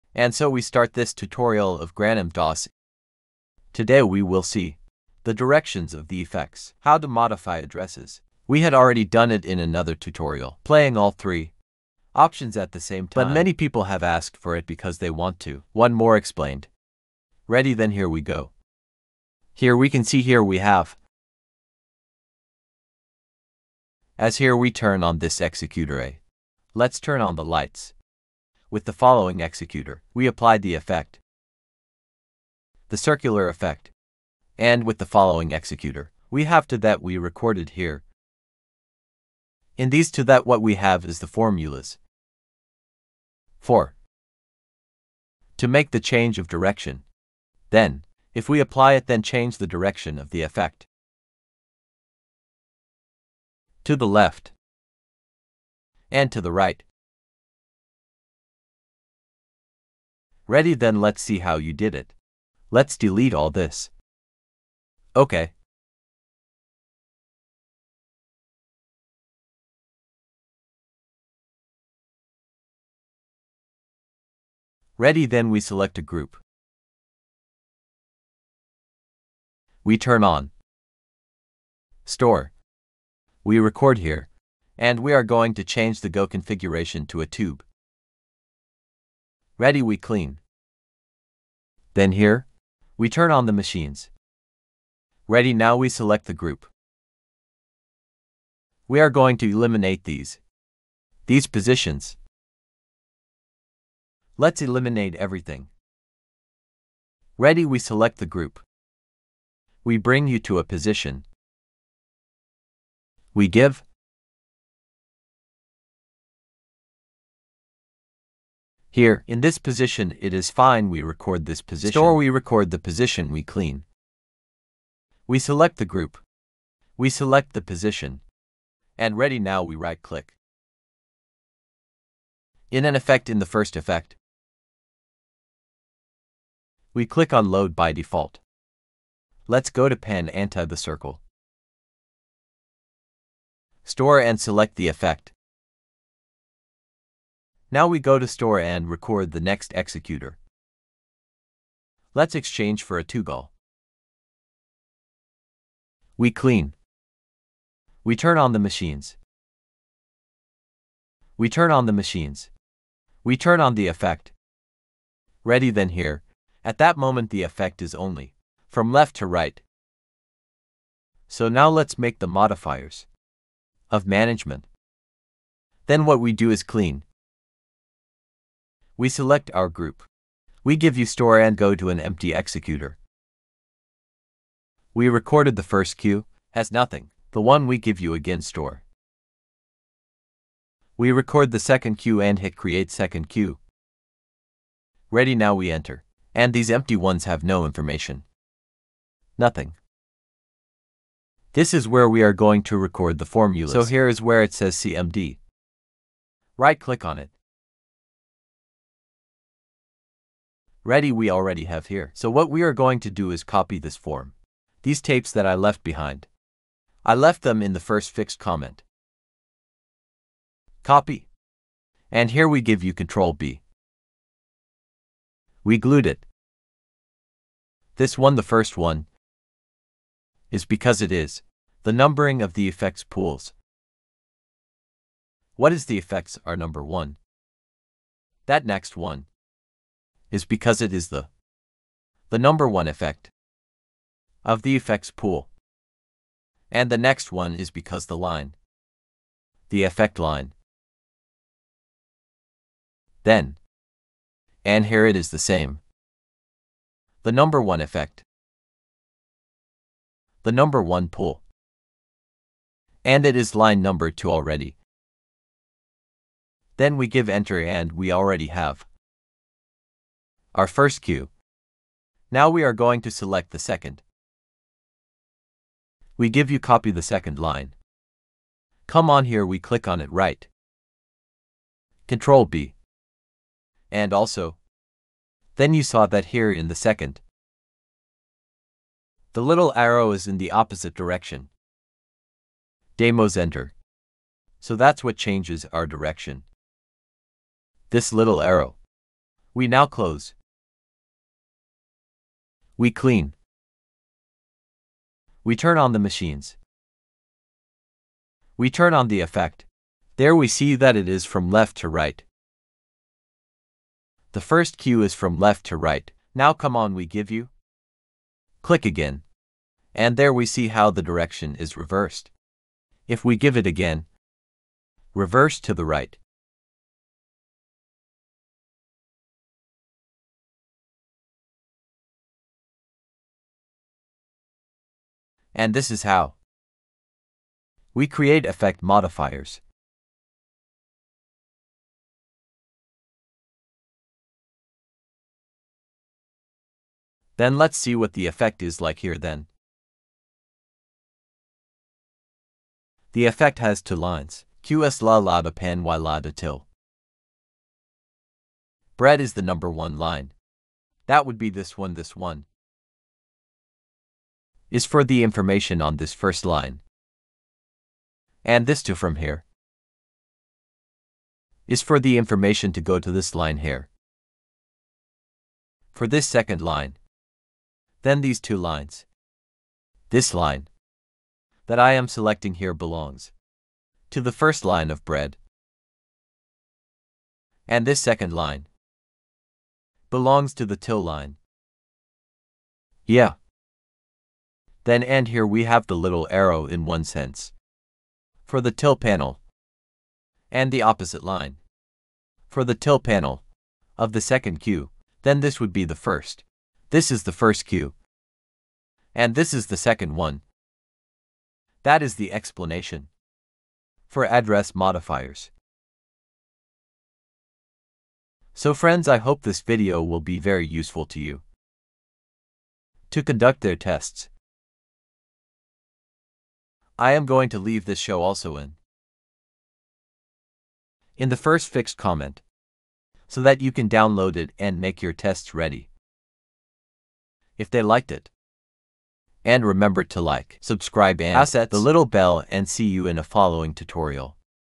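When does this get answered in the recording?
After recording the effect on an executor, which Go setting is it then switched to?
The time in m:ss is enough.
2:32.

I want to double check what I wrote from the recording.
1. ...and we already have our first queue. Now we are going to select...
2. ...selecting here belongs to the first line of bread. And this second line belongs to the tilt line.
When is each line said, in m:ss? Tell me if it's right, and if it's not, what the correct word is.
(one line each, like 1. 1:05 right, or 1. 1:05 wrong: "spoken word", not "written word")
1. 4:27 right
2. 6:22 right.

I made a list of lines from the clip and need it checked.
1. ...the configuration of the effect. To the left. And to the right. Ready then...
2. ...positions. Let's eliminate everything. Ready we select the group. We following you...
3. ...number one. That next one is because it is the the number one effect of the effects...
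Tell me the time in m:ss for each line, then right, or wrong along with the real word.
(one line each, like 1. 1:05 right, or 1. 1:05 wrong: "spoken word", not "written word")
1. 0:49 wrong: "direction", not "configuration"
2. 1:41 wrong: "bring", not "following"
3. 3:56 right.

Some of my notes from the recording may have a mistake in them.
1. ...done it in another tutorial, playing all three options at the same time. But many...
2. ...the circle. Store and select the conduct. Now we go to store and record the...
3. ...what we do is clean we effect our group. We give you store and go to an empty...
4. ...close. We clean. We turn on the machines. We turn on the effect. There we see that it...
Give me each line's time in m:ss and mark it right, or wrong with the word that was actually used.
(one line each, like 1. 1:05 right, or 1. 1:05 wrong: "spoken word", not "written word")
1. 0:09 right
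2. 2:20 wrong: "effect", not "conduct"
3. 2:56 wrong: "select", not "effect"
4. 4:59 right.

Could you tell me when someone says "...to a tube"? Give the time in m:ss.
1:27.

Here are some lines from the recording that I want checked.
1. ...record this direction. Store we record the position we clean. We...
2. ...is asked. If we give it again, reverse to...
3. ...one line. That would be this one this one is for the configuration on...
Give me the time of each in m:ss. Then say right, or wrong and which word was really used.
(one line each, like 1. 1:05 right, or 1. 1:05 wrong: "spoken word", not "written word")
1. 2:01 wrong: "position", not "direction"
2. 5:21 wrong: "reversed", not "asked"
3. 5:59 wrong: "information", not "configuration".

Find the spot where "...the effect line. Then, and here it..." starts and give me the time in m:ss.
4:09.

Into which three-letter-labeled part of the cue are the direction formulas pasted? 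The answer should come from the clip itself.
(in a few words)
CMD.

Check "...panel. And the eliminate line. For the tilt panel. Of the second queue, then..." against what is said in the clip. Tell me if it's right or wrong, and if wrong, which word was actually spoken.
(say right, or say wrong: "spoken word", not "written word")
wrong: "opposite", not "eliminate".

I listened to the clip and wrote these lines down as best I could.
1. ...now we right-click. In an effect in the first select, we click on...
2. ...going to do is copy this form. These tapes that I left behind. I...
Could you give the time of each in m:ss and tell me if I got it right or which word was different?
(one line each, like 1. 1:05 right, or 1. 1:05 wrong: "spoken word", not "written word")
1. 2:09 wrong: "effect", not "select"
2. 3:32 right.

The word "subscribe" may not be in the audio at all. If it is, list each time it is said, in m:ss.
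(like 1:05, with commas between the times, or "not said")
7:20.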